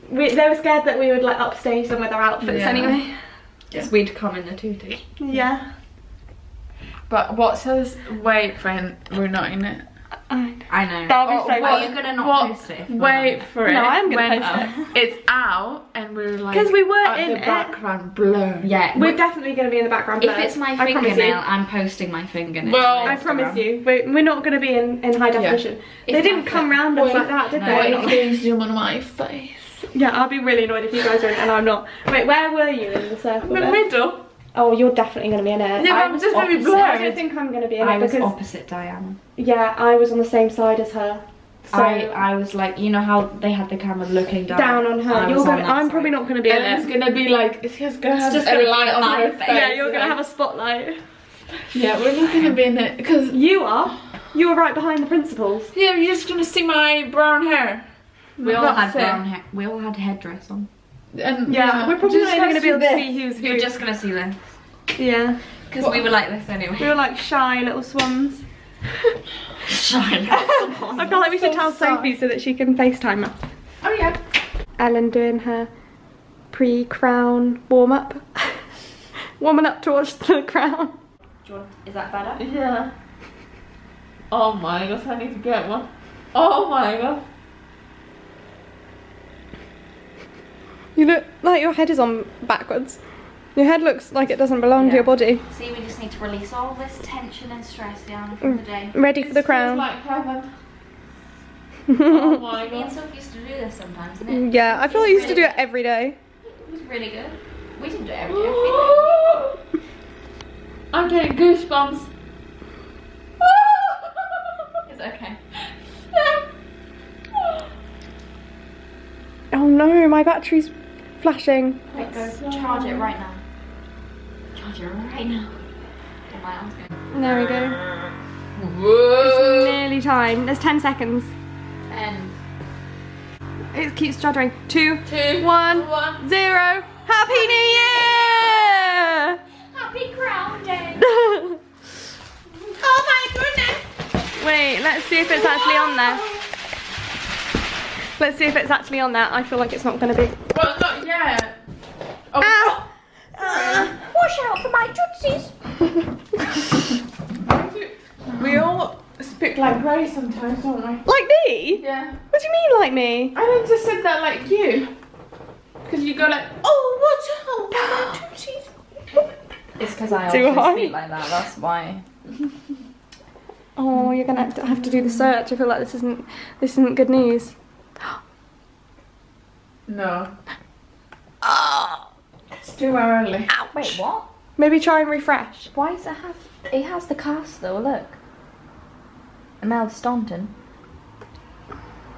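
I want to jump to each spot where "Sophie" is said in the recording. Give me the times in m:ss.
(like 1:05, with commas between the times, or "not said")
1:11, 1:42.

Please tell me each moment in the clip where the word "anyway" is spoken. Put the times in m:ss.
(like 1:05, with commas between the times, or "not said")
0:02, 1:06.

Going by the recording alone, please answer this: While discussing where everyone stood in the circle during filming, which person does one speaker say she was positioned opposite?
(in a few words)
Diana.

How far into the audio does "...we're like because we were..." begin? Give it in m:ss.
0:16.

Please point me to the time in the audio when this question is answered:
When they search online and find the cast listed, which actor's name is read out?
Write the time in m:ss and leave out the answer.
3:09.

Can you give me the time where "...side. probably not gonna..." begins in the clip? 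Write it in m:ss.
0:45.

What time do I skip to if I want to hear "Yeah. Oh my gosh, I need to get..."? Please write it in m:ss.
1:22.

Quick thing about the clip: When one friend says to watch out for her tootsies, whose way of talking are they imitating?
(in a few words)
Ray.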